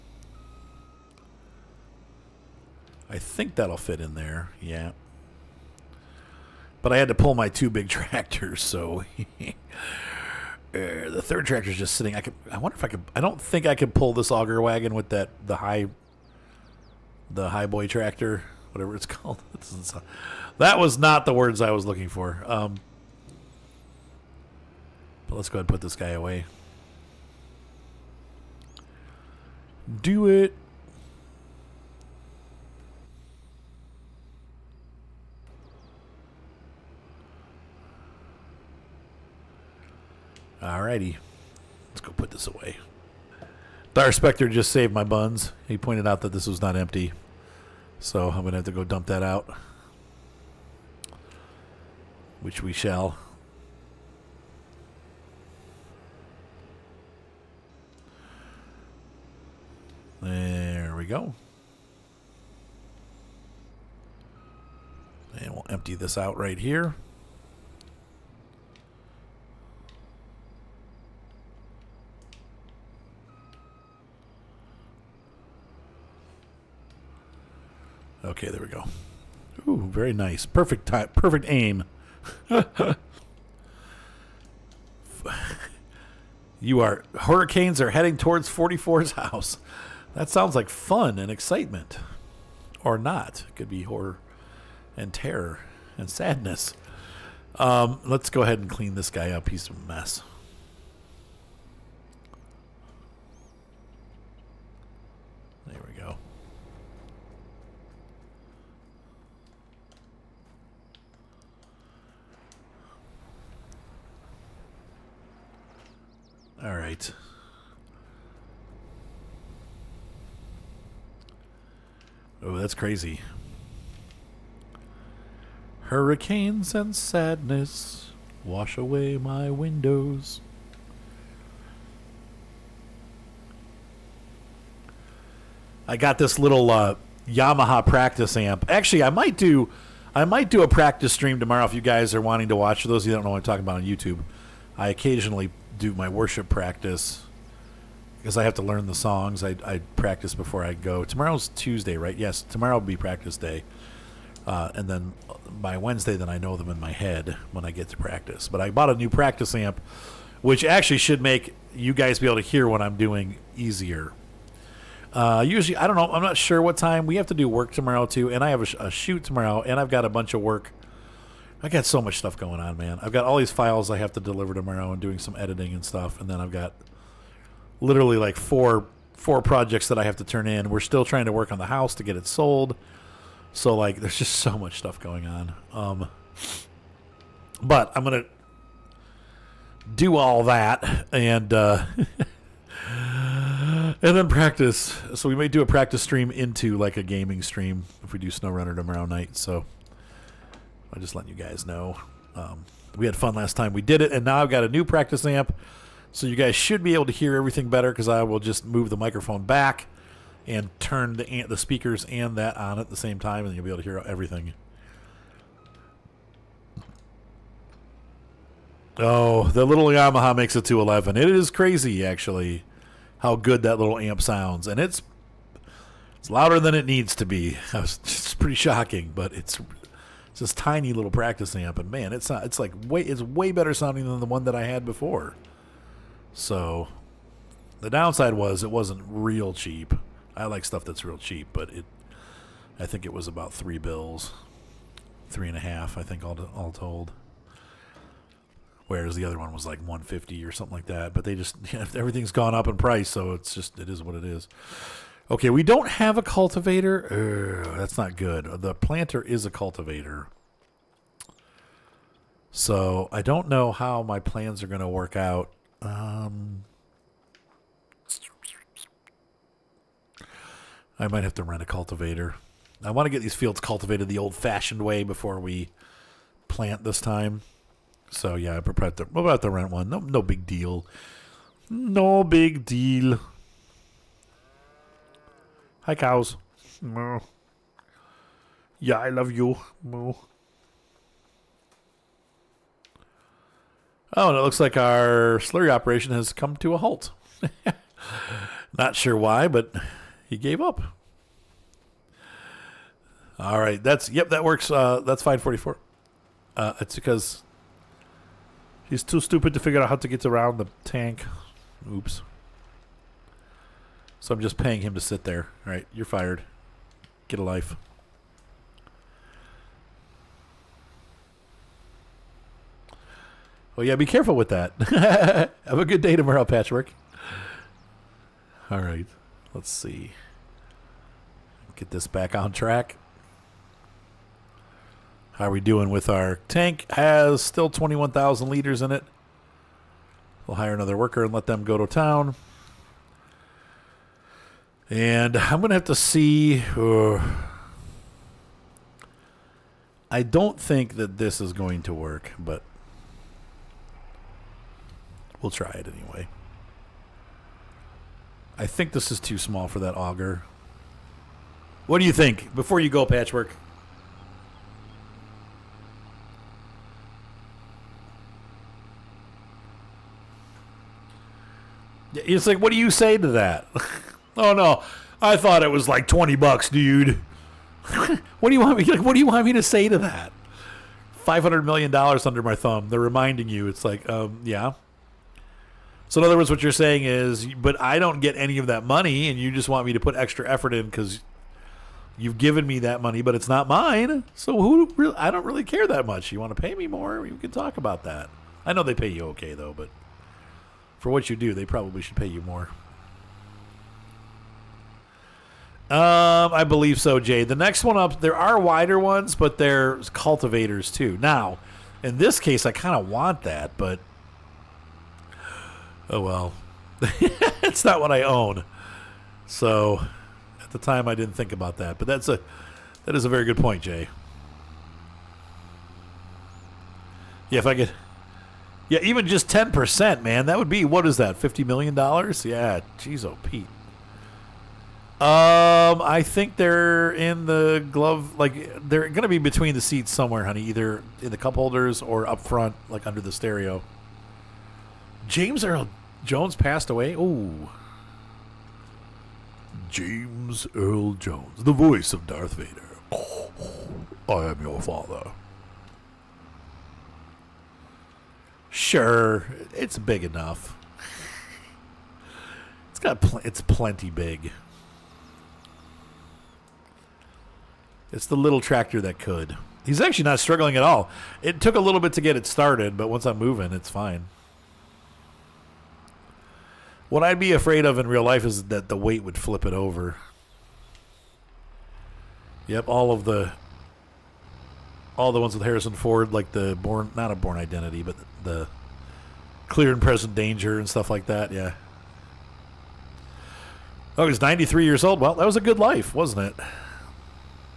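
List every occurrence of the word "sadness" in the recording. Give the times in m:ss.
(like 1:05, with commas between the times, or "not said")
1:36, 2:06.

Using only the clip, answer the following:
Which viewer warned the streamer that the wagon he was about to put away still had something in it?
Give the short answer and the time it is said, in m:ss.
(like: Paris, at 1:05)
Dire Spectre, at 0:43.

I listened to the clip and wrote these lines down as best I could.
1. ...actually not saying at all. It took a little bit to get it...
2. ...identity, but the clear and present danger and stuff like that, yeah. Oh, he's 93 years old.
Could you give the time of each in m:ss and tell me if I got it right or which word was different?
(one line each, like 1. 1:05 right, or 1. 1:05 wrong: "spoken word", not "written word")
1. 7:49 wrong: "struggling", not "saying"
2. 8:07 right.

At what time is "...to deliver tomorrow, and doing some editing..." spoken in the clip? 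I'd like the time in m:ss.
2:54.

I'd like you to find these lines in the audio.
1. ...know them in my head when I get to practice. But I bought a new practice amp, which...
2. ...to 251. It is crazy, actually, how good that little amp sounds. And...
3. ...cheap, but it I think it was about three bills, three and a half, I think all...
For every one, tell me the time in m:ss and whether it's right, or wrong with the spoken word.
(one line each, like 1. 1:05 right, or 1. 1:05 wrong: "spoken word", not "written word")
1. 2:36 right
2. 3:40 wrong: "211", not "251"
3. 4:01 right.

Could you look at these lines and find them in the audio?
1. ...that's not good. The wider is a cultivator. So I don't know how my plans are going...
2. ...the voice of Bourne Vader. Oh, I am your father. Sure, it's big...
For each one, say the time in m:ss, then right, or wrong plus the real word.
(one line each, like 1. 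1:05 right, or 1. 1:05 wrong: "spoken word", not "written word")
1. 4:17 wrong: "planter", not "wider"
2. 7:31 wrong: "Darth", not "Bourne".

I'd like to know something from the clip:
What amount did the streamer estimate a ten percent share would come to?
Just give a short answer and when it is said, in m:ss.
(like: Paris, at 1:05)
$50 million, at 7:11.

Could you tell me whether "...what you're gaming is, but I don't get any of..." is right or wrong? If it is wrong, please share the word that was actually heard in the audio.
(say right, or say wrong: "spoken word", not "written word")
wrong: "saying", not "gaming".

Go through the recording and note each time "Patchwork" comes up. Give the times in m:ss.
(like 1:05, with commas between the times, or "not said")
5:26, 6:03.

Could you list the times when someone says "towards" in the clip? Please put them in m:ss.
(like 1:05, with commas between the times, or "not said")
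1:28.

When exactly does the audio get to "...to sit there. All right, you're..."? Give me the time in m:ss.
5:14.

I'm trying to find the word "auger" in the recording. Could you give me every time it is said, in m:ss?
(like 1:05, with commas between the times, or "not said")
0:14, 5:59.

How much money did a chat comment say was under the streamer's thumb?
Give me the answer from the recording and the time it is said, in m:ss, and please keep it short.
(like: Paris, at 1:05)
$500 million, at 6:21.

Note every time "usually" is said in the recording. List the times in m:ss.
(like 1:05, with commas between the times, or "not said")
2:45.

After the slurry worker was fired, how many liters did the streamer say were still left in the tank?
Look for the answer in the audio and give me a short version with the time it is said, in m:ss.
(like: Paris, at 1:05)
21,000 liters, at 5:37.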